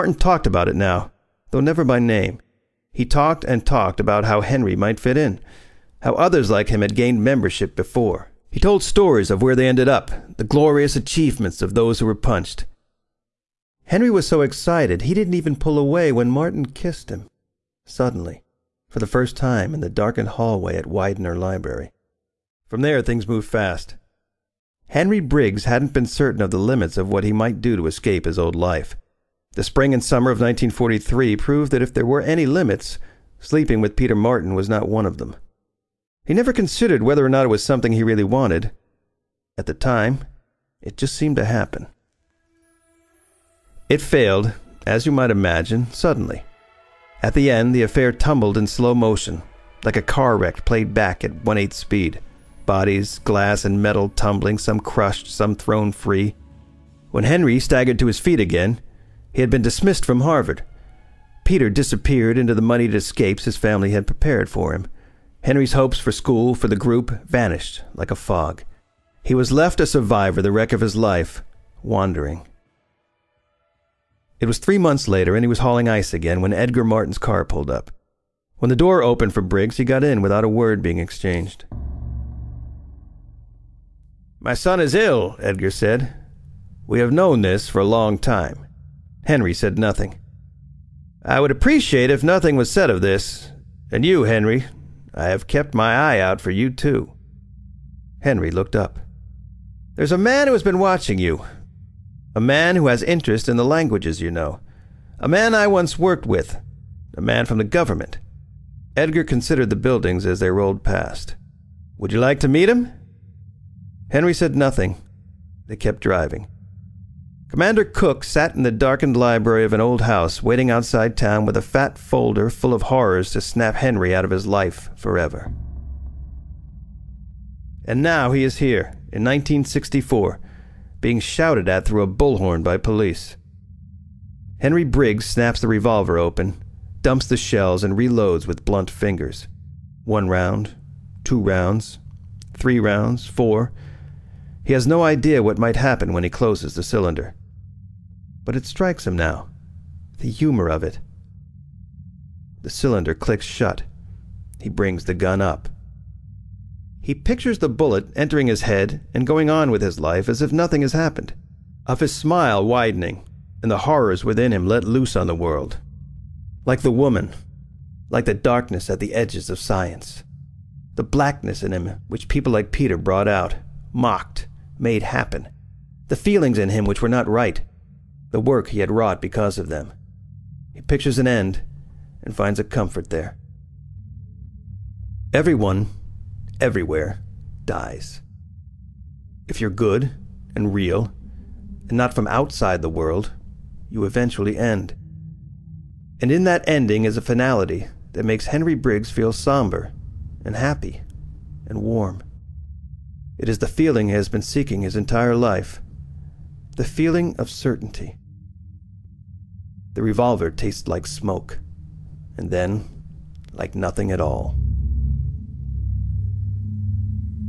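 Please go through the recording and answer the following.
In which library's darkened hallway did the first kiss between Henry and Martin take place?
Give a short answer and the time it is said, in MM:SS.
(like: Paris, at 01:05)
Widener Library, at 00:20.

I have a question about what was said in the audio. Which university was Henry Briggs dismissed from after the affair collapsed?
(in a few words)
Harvard.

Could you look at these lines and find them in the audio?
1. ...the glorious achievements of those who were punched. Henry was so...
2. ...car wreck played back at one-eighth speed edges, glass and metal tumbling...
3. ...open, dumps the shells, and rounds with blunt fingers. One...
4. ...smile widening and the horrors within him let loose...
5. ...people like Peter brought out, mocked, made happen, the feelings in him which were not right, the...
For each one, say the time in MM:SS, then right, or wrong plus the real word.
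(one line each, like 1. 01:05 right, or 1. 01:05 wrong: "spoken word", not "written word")
1. 00:10 right
2. 00:50 wrong: "bodies", not "edges"
3. 02:16 wrong: "reloads", not "rounds"
4. 02:42 right
5. 02:52 right.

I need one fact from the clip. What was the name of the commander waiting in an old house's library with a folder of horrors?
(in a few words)
Commander Cook.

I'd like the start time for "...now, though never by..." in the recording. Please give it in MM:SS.
00:00.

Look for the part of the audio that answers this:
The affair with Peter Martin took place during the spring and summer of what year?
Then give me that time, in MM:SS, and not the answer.
00:30.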